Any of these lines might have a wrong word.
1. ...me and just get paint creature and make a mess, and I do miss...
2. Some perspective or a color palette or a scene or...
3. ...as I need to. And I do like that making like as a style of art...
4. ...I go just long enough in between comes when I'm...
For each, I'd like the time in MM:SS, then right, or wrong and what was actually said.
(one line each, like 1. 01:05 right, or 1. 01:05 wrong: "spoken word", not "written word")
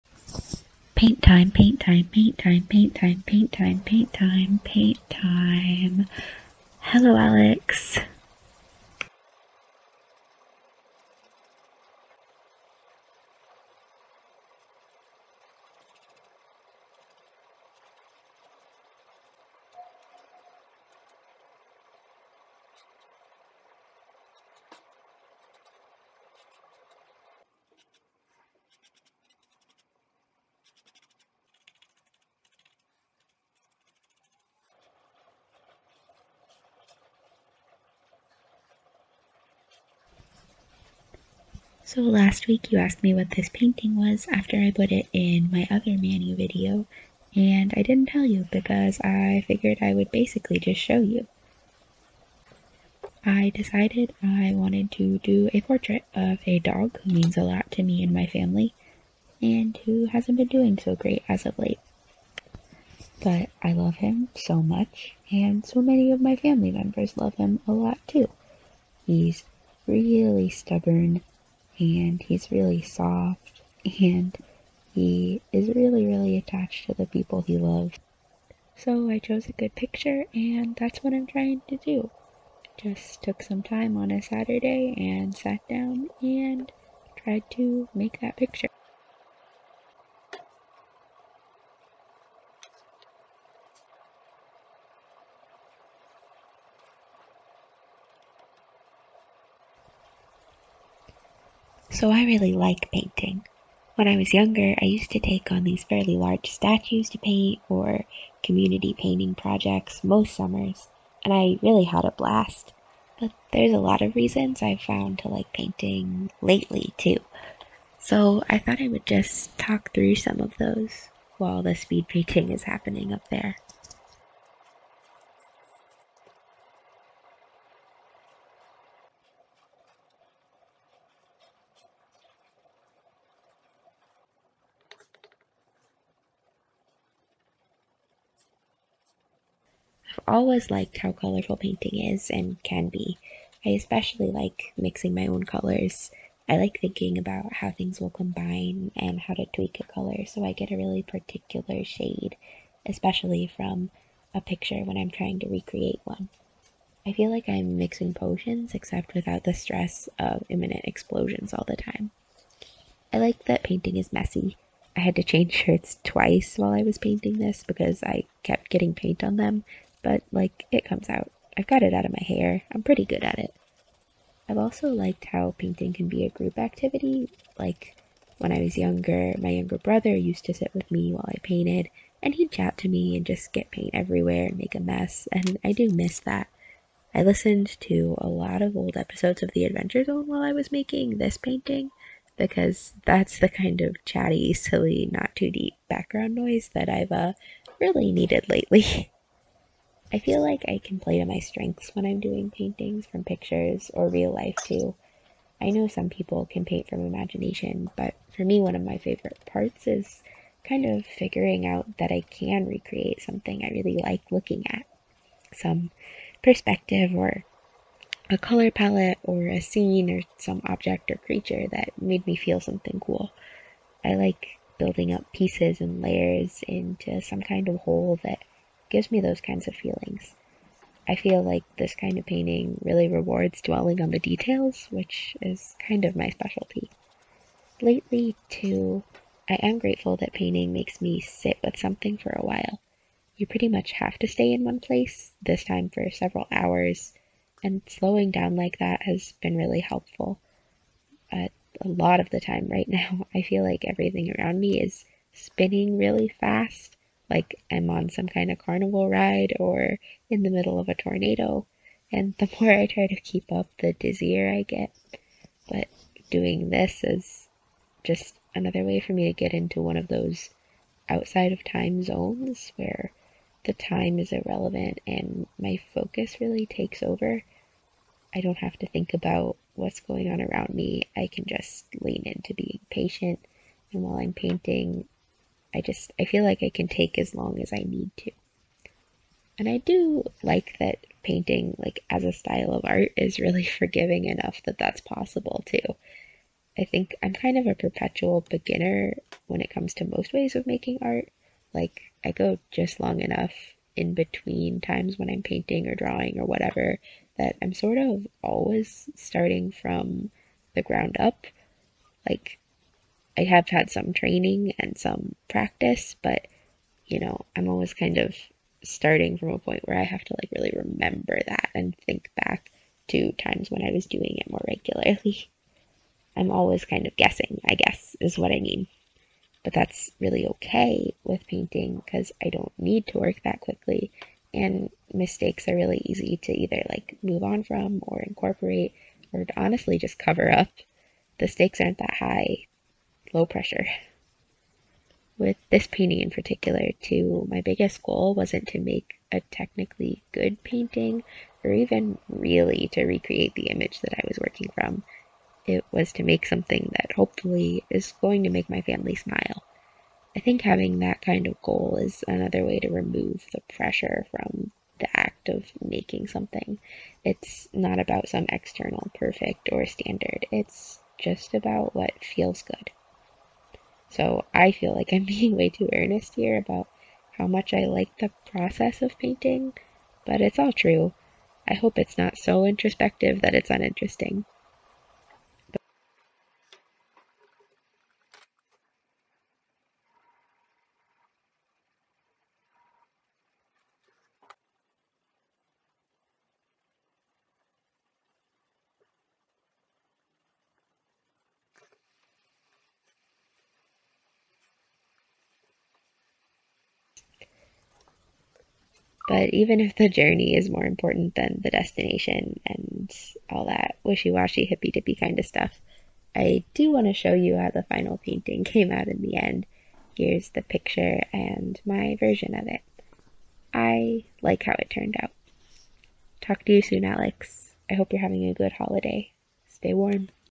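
1. 03:02 wrong: "everywhere", not "creature"
2. 03:35 right
3. 04:47 wrong: "painting", not "making"
4. 05:02 wrong: "times", not "comes".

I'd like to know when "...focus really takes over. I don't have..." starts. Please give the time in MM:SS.
04:35.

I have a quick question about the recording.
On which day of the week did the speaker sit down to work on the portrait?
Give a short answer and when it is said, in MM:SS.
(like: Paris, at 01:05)
Saturday, at 01:24.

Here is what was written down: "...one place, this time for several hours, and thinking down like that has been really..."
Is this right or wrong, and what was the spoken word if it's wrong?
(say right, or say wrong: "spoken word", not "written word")
wrong: "slowing", not "thinking".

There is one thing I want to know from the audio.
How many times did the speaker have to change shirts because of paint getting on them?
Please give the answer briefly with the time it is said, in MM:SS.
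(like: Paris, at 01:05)
Twice, at 02:46.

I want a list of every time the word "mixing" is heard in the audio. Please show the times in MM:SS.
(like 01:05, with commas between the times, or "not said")
02:24, 02:37.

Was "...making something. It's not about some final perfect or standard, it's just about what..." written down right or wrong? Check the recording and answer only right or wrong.
wrong.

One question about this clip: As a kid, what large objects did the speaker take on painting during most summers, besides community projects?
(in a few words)
Statues.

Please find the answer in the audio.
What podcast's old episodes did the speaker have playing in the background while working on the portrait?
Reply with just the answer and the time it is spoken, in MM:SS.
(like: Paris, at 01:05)
The Adventure Zone, at 03:09.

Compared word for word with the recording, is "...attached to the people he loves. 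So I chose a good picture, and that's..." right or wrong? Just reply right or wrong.
right.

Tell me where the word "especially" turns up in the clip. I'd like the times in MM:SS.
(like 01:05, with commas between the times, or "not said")
02:23, 02:32.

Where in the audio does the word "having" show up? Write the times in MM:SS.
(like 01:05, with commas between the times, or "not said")
06:00, 07:08.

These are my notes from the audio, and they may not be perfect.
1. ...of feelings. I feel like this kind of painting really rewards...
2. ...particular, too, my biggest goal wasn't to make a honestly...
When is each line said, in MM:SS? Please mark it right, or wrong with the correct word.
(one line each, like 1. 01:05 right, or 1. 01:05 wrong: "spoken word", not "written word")
1. 03:49 right
2. 05:46 wrong: "technically", not "honestly".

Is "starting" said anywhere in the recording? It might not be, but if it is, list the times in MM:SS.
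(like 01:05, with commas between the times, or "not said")
05:09, 05:18.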